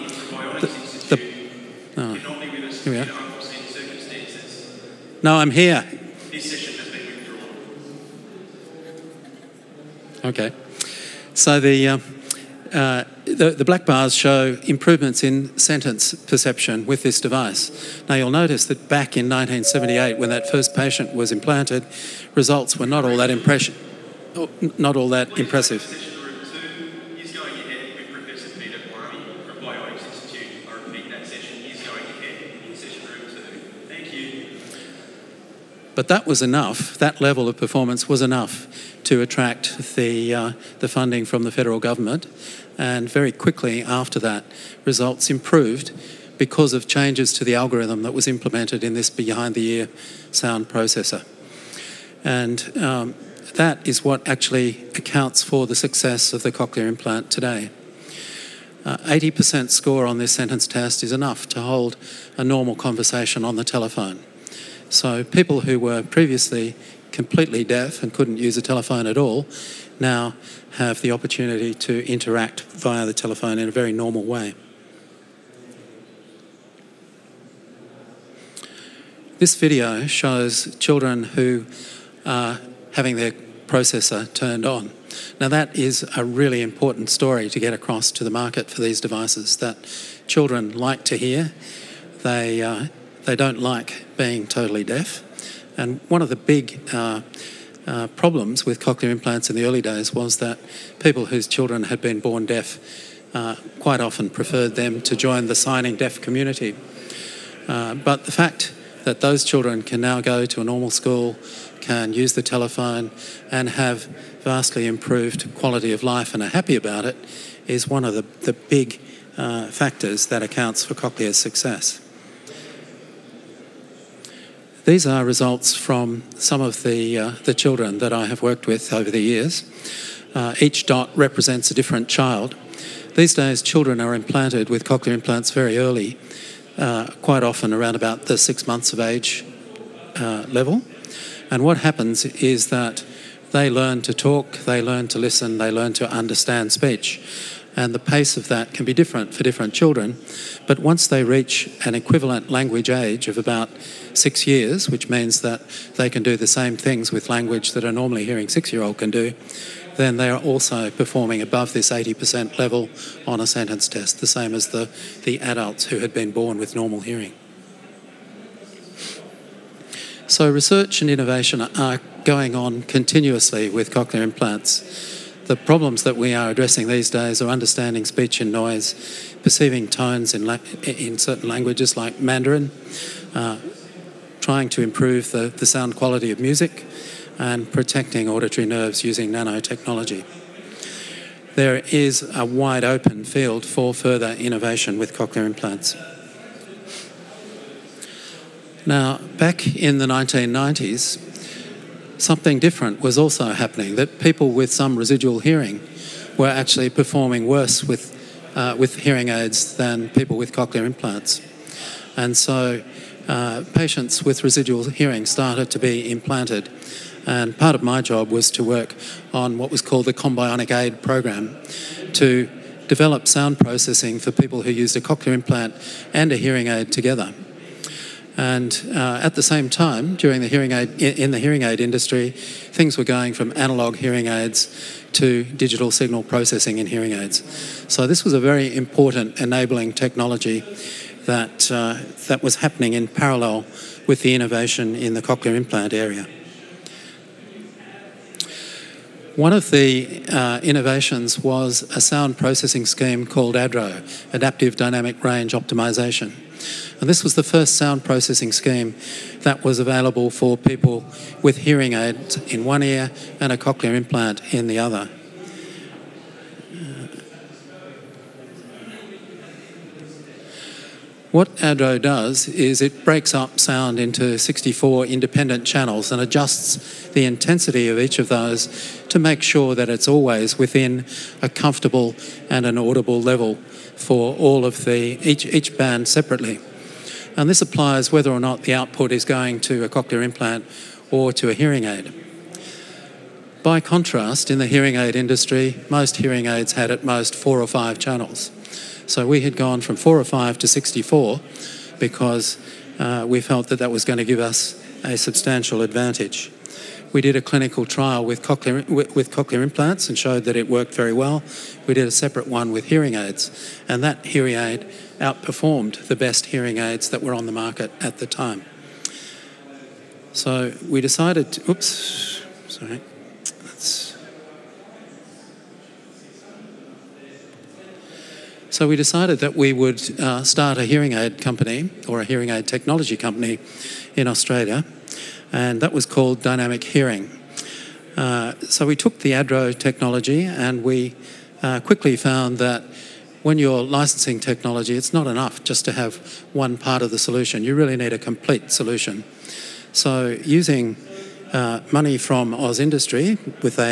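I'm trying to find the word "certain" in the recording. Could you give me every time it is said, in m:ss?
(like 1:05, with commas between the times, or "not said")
3:01.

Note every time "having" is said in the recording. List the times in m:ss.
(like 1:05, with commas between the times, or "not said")
1:22.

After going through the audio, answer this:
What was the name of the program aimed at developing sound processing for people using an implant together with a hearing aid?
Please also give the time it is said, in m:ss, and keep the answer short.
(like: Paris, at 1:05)
Combionic Aid Program, at 3:40.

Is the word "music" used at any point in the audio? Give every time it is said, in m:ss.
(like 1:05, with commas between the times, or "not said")
3:06.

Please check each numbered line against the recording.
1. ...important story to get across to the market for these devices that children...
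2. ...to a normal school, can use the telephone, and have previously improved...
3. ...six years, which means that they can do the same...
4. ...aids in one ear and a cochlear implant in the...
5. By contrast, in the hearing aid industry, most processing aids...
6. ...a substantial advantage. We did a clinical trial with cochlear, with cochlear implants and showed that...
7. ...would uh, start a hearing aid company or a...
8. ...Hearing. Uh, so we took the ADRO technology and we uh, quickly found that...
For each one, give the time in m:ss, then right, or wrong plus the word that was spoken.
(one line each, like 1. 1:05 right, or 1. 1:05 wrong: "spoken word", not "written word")
1. 1:26 right
2. 1:50 wrong: "vastly", not "previously"
3. 2:34 right
4. 4:21 right
5. 4:53 wrong: "hearing", not "processing"
6. 5:05 right
7. 5:29 right
8. 5:36 right.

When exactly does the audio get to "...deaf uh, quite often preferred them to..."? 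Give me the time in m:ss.
1:42.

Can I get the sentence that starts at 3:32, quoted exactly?
And so uh, patients with residual hearing started to be implanted.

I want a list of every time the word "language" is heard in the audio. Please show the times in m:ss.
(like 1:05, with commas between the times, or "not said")
2:32, 2:37, 3:01.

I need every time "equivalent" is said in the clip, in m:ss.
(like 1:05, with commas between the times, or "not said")
2:31.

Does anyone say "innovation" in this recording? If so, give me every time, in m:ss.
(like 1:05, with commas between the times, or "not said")
2:51, 3:14, 4:04, 4:10.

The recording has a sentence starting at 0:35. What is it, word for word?
But that was enough, that level of performance was enough to attract the, uh, the funding from the federal government.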